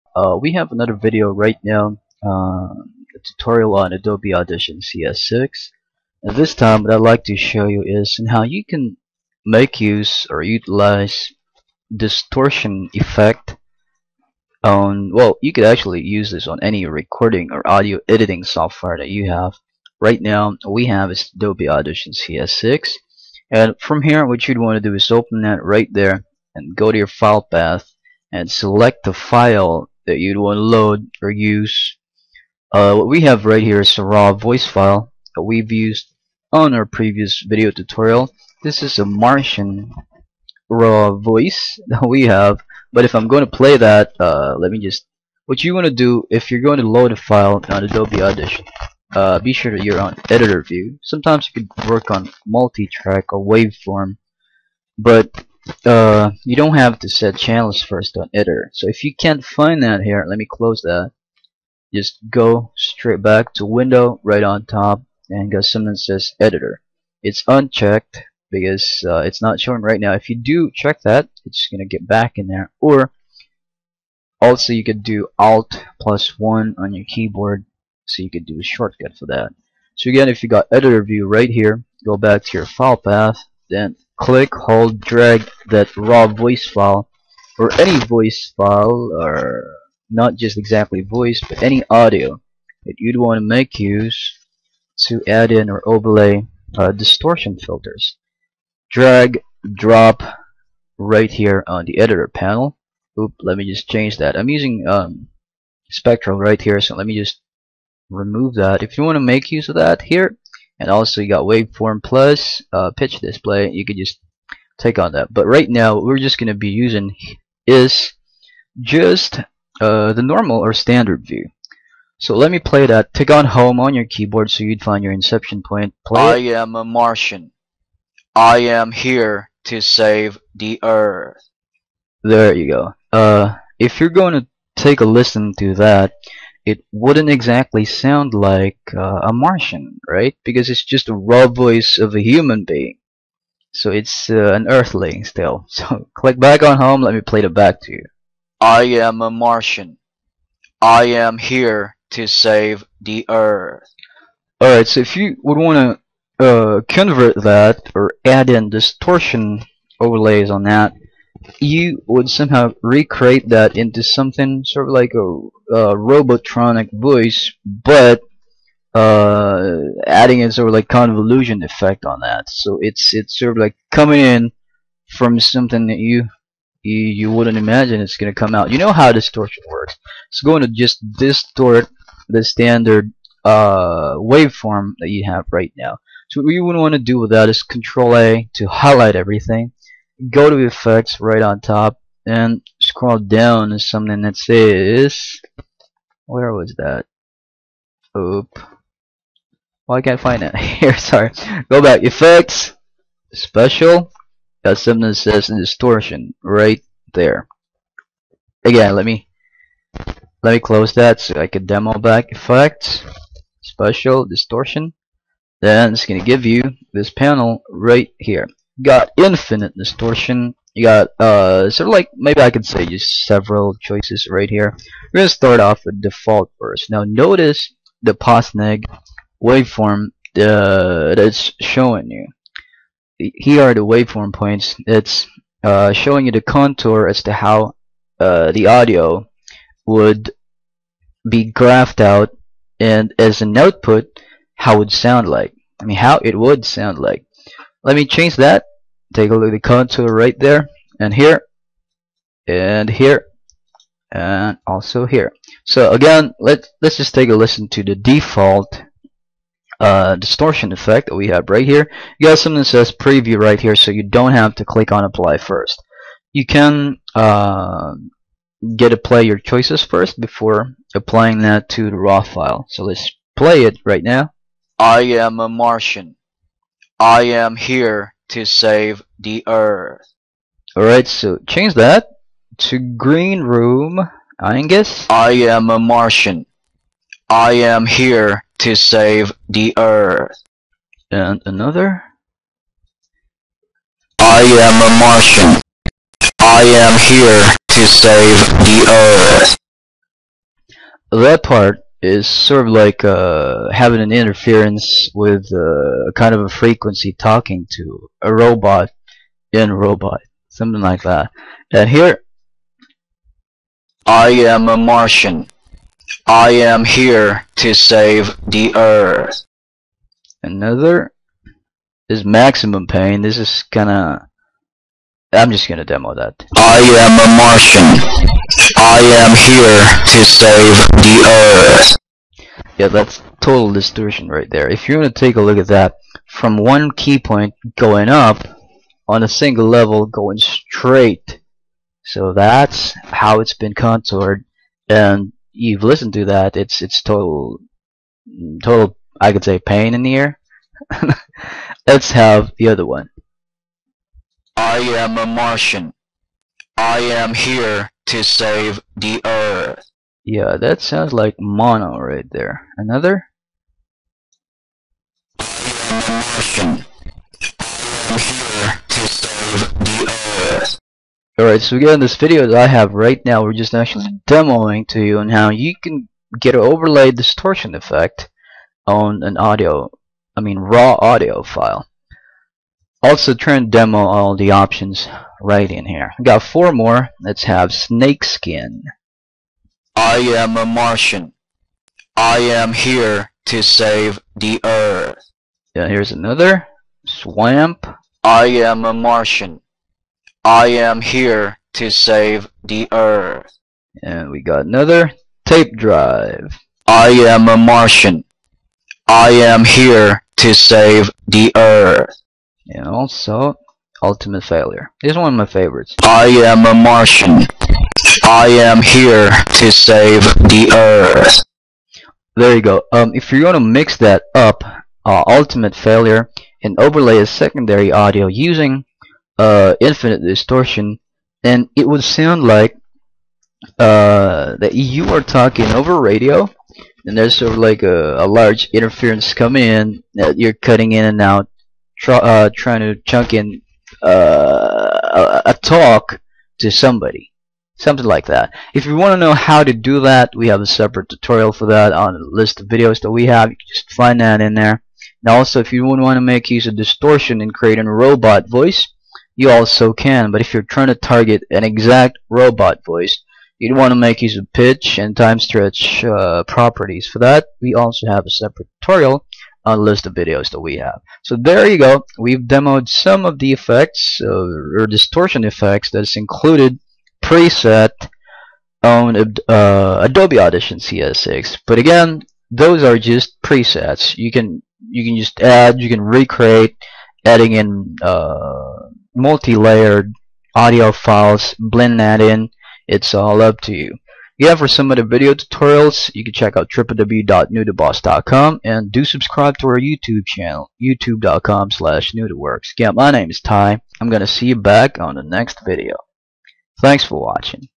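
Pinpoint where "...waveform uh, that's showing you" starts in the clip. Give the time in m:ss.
3:49.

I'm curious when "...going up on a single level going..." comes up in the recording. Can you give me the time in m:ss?
5:37.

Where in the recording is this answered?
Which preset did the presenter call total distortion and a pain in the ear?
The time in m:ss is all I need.
5:22.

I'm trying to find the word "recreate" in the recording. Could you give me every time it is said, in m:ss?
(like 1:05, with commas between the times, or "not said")
2:42, 8:06.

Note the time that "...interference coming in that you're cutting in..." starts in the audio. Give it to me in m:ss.
7:18.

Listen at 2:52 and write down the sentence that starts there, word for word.
So it's it's sort of like coming in from something that you you, you wouldn't imagine it's gonna come out.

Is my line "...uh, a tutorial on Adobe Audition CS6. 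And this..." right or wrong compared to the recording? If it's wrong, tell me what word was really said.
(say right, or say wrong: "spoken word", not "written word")
right.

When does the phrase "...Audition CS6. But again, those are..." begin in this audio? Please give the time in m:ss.
8:00.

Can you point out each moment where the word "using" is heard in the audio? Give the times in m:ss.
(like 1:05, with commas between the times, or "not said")
1:44, 1:56, 7:08.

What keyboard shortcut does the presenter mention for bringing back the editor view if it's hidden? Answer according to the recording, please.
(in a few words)
Alt+1.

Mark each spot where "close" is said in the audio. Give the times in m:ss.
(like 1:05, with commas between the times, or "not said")
1:00, 3:30.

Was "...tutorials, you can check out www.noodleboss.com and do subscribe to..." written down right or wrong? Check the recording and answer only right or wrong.
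right.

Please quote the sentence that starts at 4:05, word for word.
I mean how it would sound like.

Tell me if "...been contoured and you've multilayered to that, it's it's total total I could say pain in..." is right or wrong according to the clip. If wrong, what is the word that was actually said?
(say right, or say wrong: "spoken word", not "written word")
wrong: "listened", not "multilayered".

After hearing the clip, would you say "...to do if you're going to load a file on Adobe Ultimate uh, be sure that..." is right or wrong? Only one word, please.
wrong.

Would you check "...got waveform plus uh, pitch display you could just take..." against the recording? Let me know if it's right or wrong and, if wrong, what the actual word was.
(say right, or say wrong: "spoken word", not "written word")
right.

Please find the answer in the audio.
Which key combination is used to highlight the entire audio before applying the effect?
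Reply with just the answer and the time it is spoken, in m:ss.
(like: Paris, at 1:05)
Control A, at 3:07.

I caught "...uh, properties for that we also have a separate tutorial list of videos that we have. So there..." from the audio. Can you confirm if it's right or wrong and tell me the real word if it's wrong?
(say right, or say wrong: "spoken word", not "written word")
right.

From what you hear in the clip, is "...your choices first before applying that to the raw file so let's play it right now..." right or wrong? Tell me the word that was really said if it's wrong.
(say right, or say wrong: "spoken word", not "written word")
right.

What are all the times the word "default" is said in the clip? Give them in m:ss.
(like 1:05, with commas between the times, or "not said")
3:46, 4:17.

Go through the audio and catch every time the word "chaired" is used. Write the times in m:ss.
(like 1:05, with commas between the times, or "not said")
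not said.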